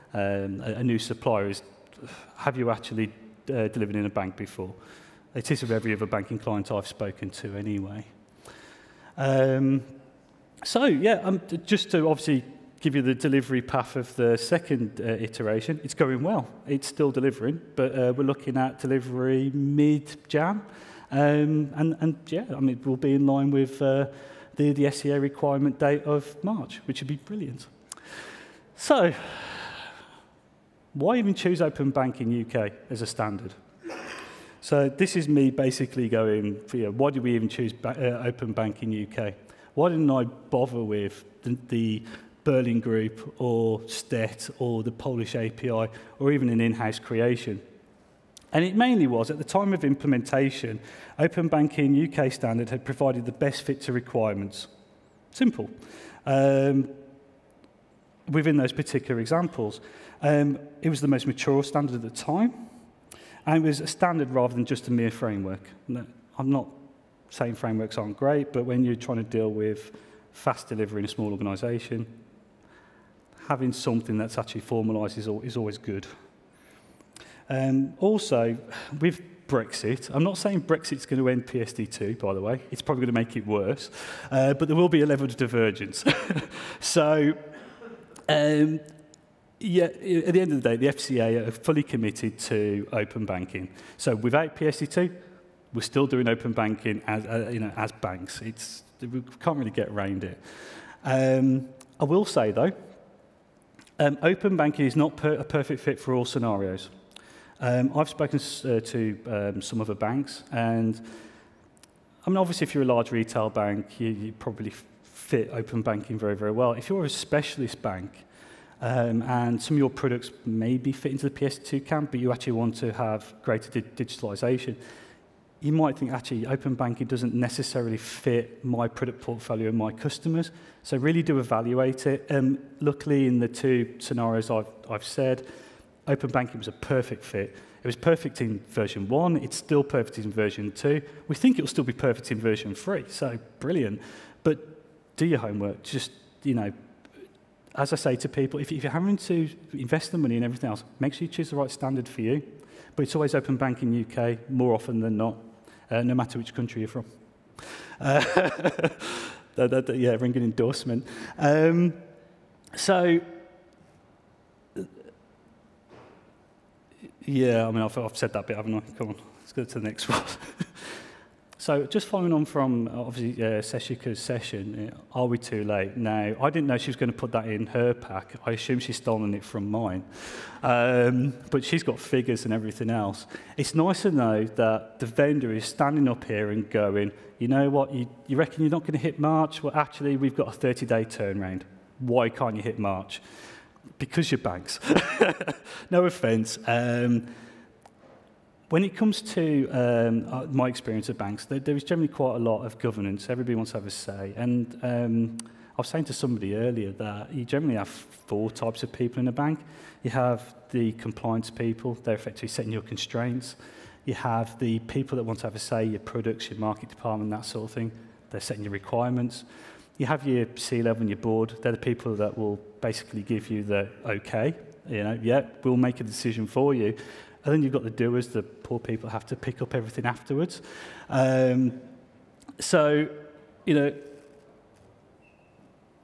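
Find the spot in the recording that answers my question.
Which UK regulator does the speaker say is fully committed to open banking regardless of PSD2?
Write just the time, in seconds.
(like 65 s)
90 s.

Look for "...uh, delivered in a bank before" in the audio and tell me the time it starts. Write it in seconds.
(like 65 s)
3 s.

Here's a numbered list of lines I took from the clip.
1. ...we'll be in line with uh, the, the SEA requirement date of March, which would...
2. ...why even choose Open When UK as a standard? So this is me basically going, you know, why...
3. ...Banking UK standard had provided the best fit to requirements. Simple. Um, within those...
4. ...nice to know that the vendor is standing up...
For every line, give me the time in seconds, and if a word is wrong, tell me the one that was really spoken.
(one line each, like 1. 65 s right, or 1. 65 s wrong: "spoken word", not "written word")
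1. 22 s right
2. 30 s wrong: "Banking", not "When"
3. 51 s right
4. 183 s right.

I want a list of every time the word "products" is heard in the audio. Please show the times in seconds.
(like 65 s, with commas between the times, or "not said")
119 s, 128 s, 215 s.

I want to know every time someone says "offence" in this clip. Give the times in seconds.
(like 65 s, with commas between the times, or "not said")
196 s.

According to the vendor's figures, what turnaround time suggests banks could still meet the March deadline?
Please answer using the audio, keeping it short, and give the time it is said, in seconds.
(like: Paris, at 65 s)
30 days, at 190 s.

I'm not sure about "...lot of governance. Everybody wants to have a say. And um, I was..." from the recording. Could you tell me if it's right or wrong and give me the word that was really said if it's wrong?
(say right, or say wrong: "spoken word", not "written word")
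right.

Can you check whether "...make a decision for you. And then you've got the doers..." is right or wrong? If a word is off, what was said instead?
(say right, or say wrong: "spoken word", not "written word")
right.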